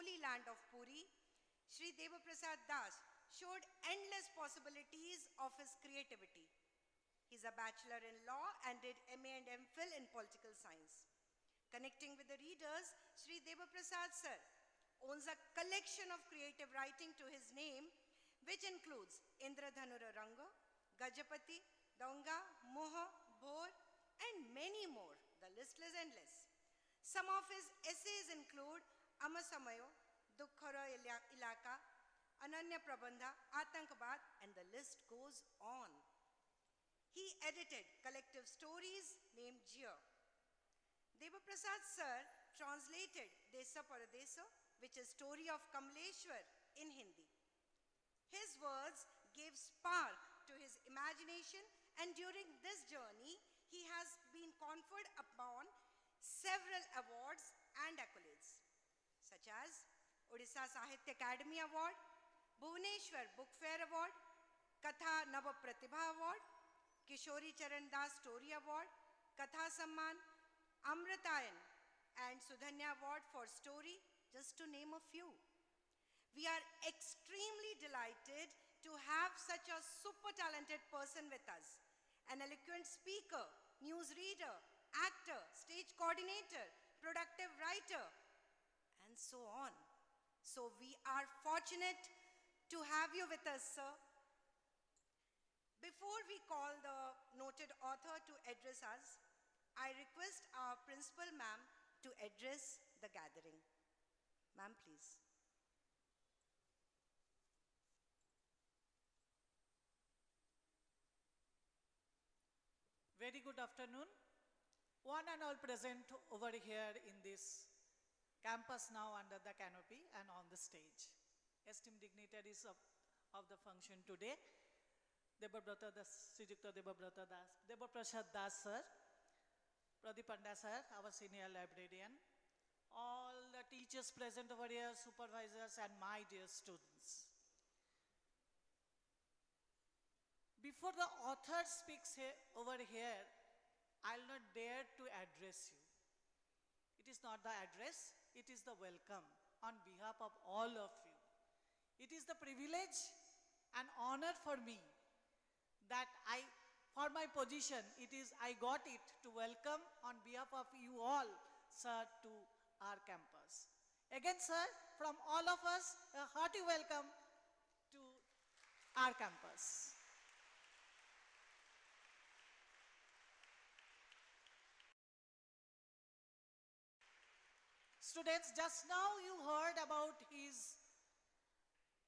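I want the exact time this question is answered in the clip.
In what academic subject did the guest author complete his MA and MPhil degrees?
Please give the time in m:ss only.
0:10.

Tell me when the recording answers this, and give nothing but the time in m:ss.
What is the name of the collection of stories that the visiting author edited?
0:39.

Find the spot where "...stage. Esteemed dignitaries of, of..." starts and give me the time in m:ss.
2:00.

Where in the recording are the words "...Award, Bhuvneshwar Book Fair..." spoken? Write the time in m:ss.
1:01.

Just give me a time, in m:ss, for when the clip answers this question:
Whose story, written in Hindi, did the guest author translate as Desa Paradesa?
0:45.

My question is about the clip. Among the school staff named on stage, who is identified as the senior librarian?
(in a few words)
Pradip Panda.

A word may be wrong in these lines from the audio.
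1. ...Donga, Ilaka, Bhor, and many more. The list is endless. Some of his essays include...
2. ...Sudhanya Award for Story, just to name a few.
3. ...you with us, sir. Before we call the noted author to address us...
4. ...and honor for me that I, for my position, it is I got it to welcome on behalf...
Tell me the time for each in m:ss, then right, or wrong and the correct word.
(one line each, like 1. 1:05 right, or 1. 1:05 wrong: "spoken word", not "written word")
1. 0:21 wrong: "Moha", not "Ilaka"
2. 1:12 right
3. 1:33 right
4. 2:33 right.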